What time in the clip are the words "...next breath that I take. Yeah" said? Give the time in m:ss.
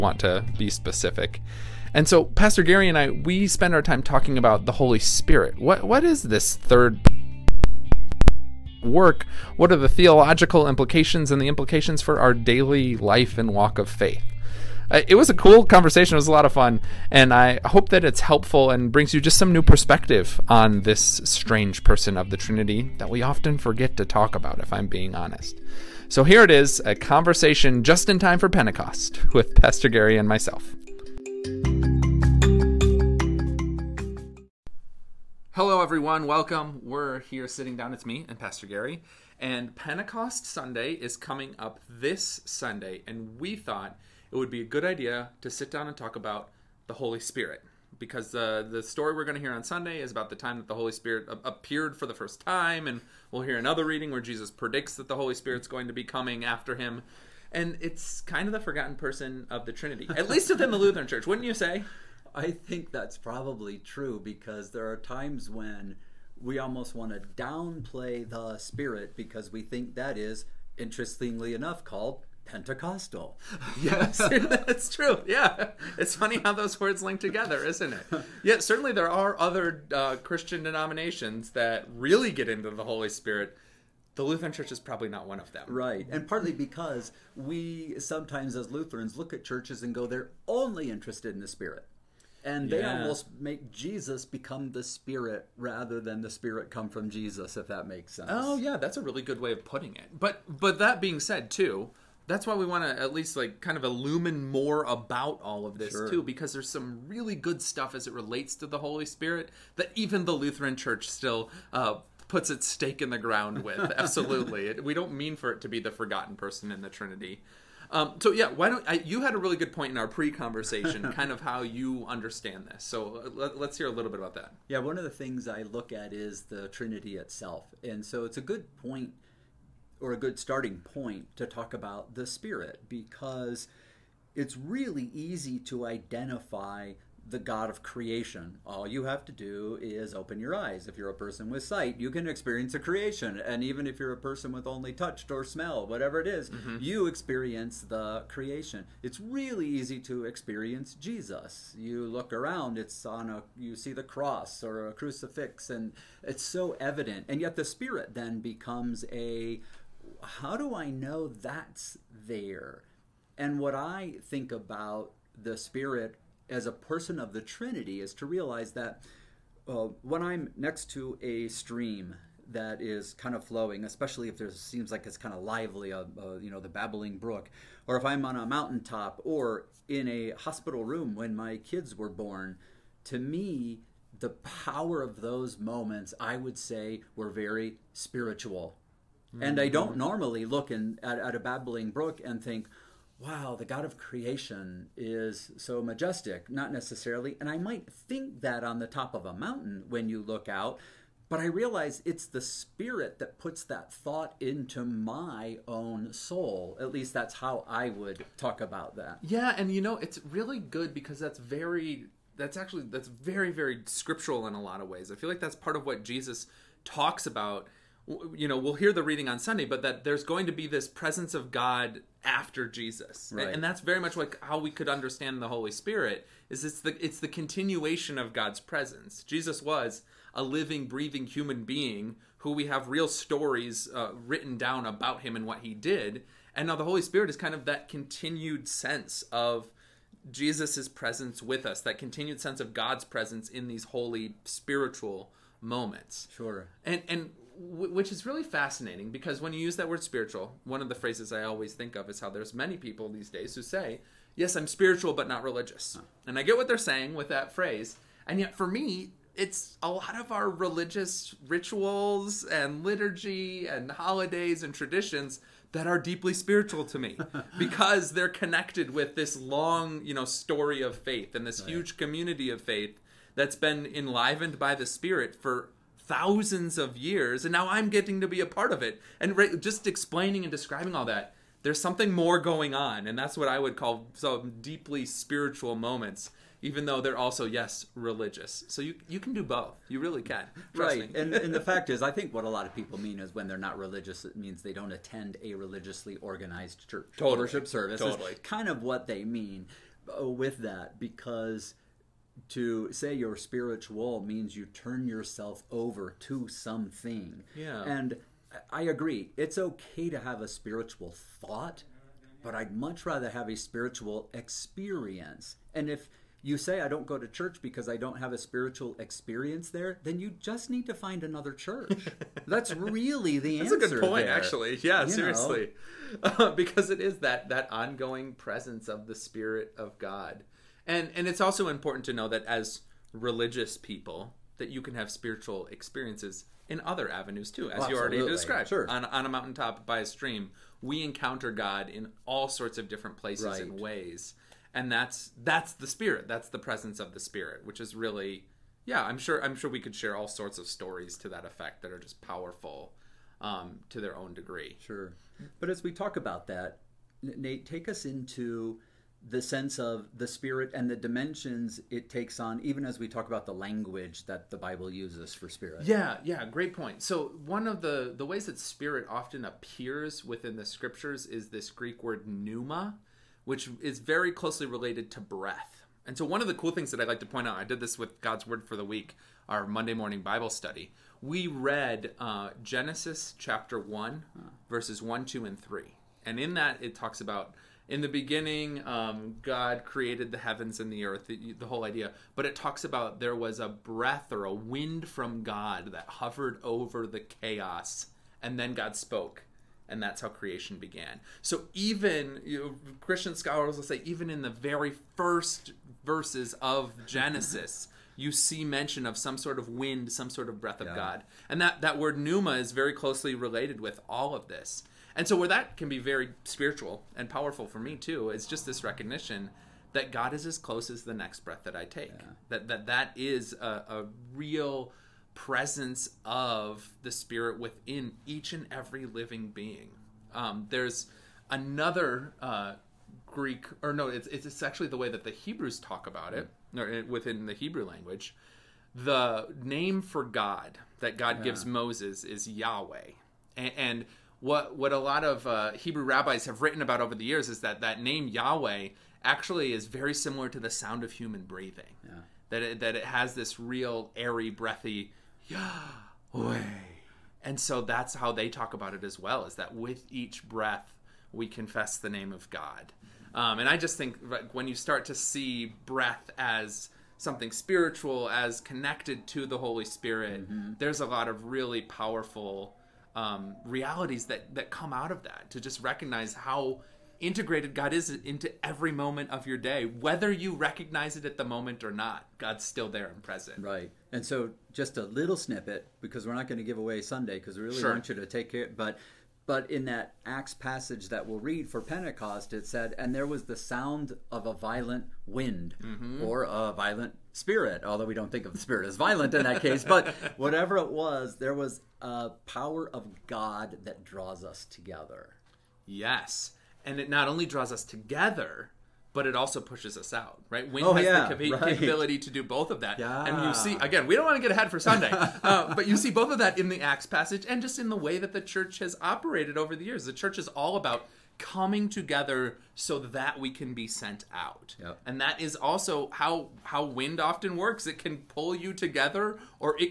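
7:01.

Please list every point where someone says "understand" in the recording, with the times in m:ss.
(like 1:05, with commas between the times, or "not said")
2:02, 3:44.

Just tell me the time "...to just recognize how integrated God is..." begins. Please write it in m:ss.
7:55.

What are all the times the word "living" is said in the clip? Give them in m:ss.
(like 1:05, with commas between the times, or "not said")
3:50, 7:09.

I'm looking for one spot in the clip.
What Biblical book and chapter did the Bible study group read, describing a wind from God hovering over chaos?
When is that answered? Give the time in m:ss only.
6:22.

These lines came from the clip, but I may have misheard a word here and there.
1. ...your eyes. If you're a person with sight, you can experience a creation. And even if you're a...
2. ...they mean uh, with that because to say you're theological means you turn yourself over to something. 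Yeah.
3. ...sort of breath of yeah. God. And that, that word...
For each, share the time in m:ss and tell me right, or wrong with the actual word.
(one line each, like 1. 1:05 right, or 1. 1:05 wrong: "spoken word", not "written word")
1. 2:20 right
2. 4:59 wrong: "spiritual", not "theological"
3. 6:50 right.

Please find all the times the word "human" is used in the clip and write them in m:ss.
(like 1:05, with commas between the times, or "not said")
3:51, 7:31.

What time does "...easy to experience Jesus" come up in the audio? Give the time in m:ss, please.
2:29.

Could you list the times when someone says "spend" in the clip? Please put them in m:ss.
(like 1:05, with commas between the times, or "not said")
0:03.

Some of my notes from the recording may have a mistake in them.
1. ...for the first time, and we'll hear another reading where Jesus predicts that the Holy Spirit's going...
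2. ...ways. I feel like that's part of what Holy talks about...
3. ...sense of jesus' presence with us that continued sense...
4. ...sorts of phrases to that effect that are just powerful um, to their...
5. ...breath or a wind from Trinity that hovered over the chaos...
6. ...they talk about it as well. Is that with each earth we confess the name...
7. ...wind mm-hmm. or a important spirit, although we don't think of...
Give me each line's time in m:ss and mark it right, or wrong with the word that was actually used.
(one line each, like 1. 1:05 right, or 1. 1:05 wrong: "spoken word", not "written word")
1. 0:51 right
2. 3:34 wrong: "Jesus", not "Holy"
3. 3:58 right
4. 5:50 wrong: "stories", not "phrases"
5. 6:33 wrong: "God", not "Trinity"
6. 7:38 wrong: "breath", not "earth"
7. 8:15 wrong: "violent", not "important".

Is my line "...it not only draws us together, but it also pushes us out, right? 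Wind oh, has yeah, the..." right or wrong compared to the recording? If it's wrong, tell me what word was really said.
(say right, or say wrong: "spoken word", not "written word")
right.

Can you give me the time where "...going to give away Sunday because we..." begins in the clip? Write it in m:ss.
8:06.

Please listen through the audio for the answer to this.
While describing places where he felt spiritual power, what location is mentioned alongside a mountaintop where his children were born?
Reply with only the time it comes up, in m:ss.
3:00.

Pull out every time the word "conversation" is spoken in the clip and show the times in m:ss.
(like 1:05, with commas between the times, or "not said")
0:15, 0:26, 2:00.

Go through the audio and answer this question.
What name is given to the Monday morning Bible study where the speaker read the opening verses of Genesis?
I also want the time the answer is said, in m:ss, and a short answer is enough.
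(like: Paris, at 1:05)
God's Word for the Week, at 6:18.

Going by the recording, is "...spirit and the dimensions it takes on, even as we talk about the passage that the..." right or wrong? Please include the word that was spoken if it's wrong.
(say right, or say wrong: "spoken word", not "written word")
wrong: "language", not "passage".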